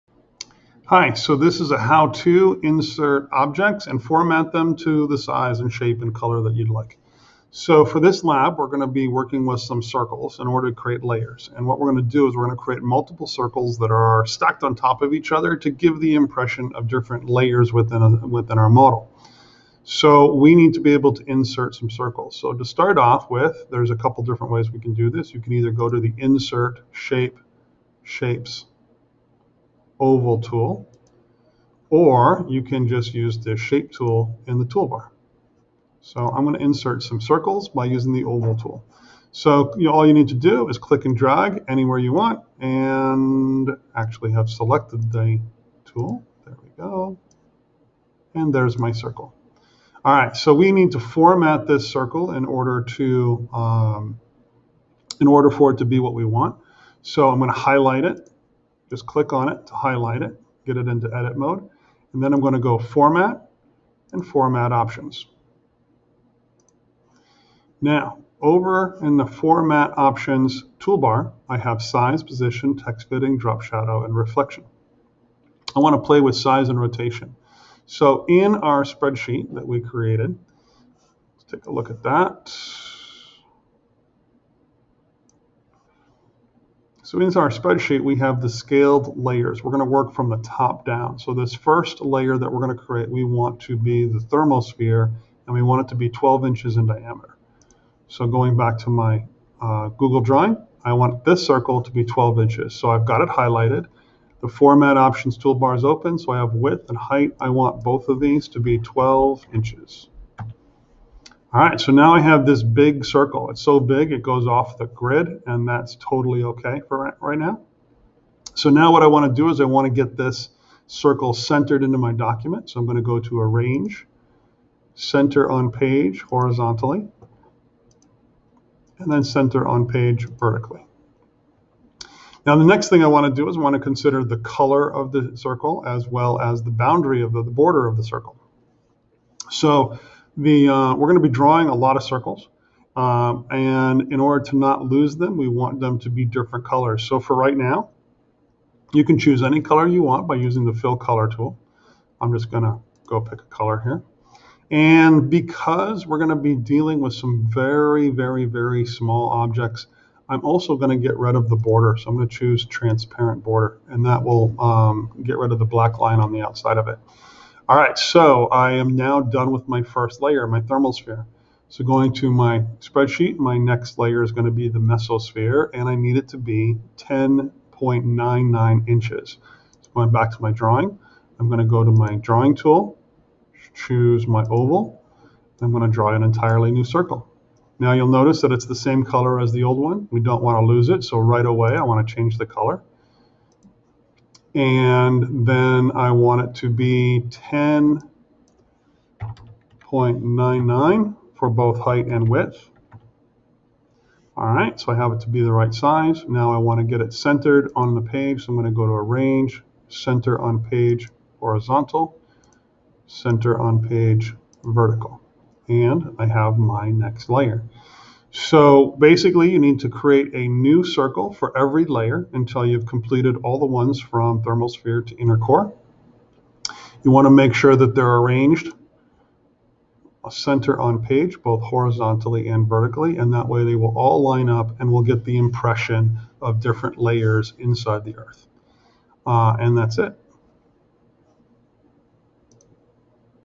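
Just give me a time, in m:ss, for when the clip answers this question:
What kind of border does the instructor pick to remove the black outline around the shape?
2:42.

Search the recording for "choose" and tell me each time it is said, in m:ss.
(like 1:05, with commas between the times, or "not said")
2:29, 2:42, 3:03.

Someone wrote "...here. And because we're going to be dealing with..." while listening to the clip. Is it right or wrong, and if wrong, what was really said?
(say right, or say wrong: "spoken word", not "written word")
right.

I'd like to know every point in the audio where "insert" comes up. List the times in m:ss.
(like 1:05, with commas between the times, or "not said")
0:02, 0:21, 0:26, 0:36.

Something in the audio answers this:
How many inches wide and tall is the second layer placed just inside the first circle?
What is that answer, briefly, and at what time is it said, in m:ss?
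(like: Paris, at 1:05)
10.99 inches, at 2:56.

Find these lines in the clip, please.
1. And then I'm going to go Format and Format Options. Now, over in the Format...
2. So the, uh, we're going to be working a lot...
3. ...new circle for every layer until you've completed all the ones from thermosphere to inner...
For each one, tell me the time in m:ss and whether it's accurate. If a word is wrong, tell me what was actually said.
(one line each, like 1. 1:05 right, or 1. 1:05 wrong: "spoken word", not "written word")
1. 1:02 right
2. 2:19 wrong: "drawing", not "working"
3. 3:40 right.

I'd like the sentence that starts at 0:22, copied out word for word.
So to start off with, there's a couple different ways we can do this.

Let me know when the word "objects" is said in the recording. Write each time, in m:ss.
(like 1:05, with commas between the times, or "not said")
0:03, 2:39.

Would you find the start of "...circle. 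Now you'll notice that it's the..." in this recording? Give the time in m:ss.
3:06.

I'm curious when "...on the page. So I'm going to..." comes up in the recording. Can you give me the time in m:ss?
3:27.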